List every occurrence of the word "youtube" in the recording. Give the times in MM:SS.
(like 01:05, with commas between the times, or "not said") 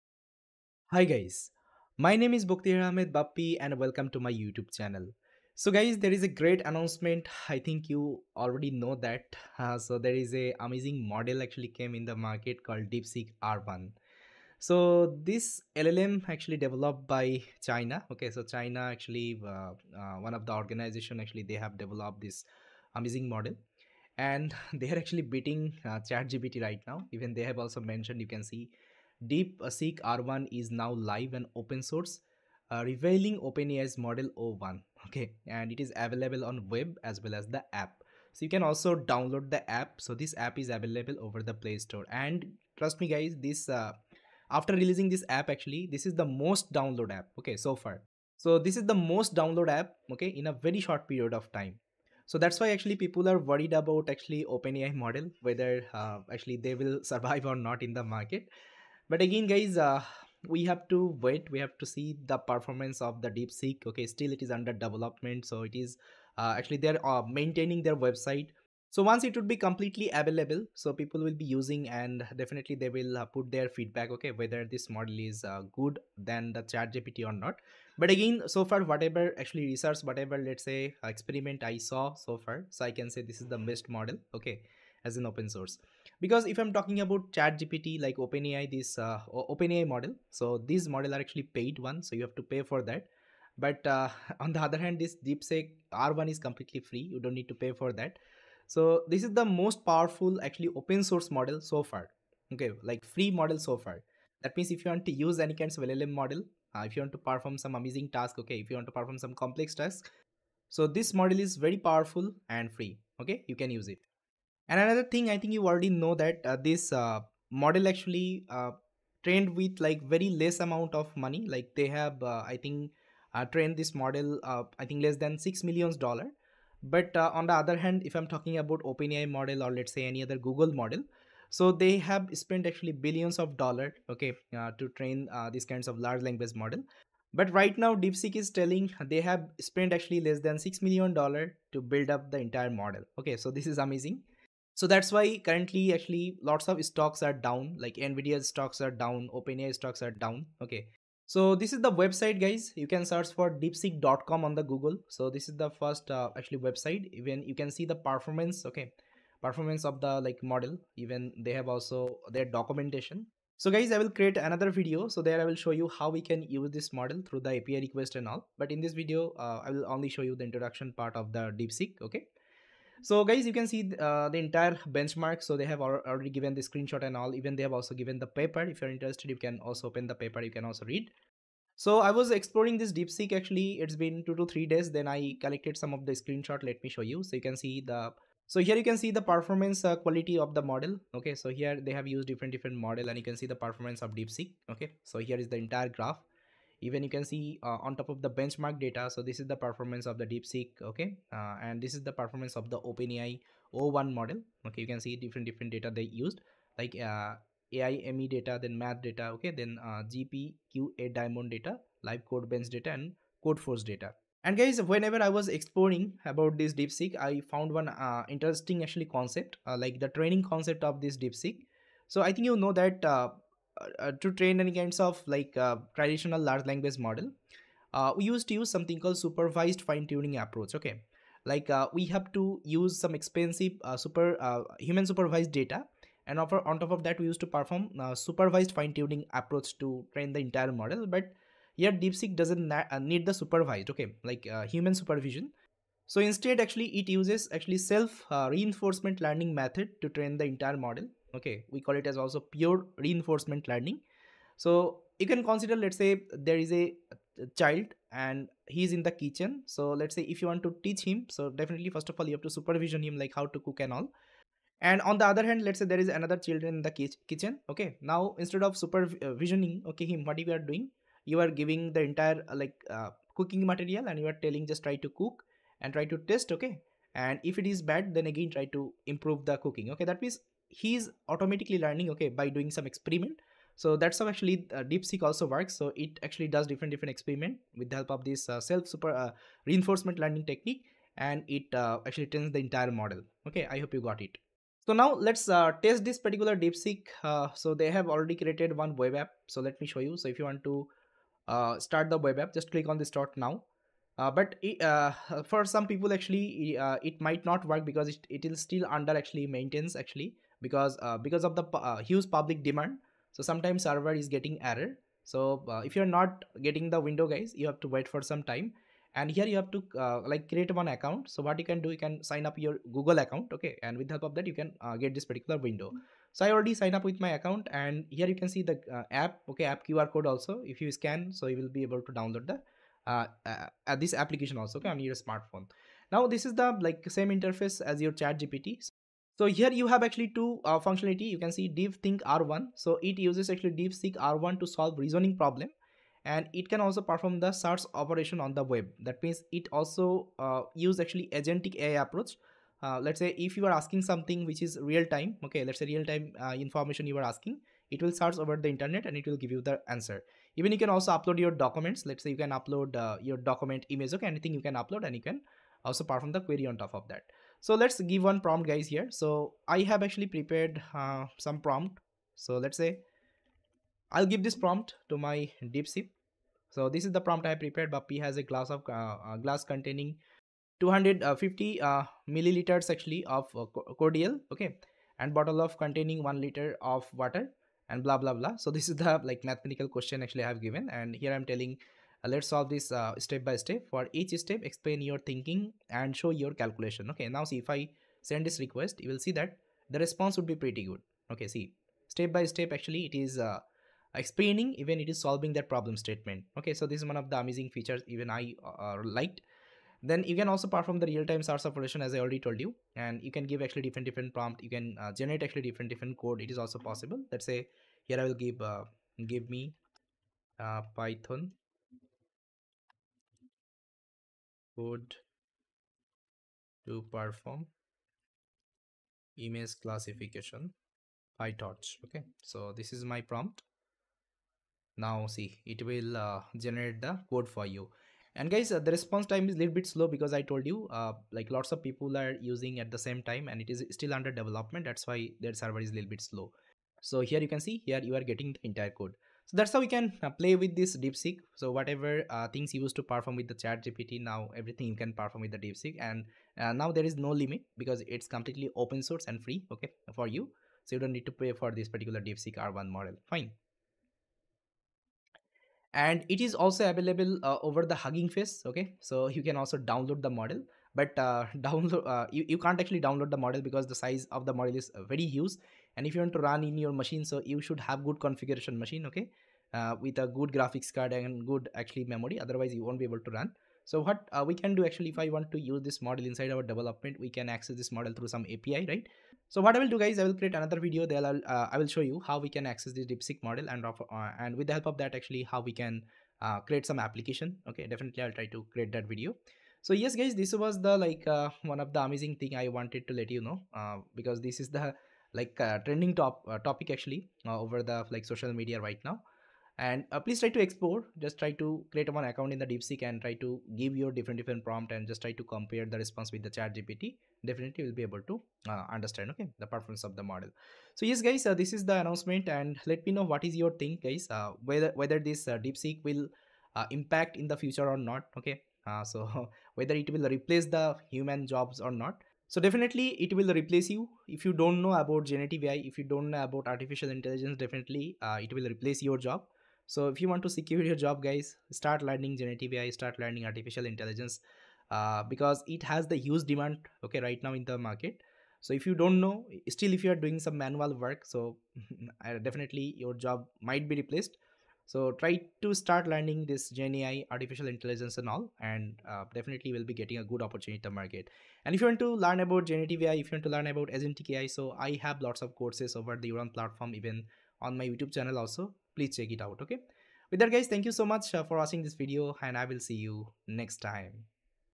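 00:04, 09:27.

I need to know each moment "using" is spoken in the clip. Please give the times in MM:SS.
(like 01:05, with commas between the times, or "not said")
01:11, 07:22.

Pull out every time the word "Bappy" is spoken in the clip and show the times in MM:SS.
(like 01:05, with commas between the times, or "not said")
00:03, 06:17.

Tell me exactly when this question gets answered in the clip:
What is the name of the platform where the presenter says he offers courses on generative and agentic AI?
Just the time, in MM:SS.
09:26.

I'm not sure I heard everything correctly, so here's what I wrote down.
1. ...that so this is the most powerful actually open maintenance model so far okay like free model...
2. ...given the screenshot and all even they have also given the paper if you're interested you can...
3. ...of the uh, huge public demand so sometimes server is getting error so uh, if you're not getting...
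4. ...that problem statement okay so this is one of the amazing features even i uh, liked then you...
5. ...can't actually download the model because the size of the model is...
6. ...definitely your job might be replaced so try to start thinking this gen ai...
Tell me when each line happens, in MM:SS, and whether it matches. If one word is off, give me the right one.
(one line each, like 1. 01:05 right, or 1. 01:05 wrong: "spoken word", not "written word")
1. 01:38 wrong: "source", not "maintenance"
2. 02:56 right
3. 05:11 right
4. 06:45 right
5. 07:52 right
6. 09:12 wrong: "learning", not "thinking".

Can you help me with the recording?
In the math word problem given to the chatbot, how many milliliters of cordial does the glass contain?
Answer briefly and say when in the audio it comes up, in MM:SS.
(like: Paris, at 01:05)
250, at 06:20.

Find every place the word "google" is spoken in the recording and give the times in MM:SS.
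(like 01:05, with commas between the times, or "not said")
02:10, 02:34, 05:22.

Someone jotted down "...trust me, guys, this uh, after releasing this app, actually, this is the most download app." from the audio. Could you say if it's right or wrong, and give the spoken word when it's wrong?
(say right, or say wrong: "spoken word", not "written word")
right.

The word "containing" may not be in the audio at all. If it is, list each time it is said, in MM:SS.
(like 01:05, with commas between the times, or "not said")
06:19, 06:25.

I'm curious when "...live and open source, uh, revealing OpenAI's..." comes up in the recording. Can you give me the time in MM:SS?
00:30.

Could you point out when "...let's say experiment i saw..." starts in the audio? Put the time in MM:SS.
01:20.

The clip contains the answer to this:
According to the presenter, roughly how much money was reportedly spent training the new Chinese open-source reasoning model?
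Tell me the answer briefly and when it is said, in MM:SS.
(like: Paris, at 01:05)
less than 6 million dollars, at 02:05.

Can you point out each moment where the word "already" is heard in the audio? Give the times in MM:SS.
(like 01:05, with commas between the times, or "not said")
00:08, 01:55, 02:55, 04:58, 05:26, 06:52.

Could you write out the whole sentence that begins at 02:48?
But in this video, uh, I will only show you the introduction part of the DeepSeek.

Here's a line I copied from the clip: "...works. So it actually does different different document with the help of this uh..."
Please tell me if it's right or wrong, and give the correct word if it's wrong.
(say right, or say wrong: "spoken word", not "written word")
wrong: "experiment", not "document".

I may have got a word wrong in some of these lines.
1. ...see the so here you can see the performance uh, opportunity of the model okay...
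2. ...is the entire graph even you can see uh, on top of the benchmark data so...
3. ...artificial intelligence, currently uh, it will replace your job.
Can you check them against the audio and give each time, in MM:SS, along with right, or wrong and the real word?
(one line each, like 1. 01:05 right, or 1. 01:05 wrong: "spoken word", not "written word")
1. 03:07 wrong: "quality", not "opportunity"
2. 03:15 right
3. 08:56 wrong: "definitely", not "currently".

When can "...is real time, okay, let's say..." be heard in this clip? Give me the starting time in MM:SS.
05:54.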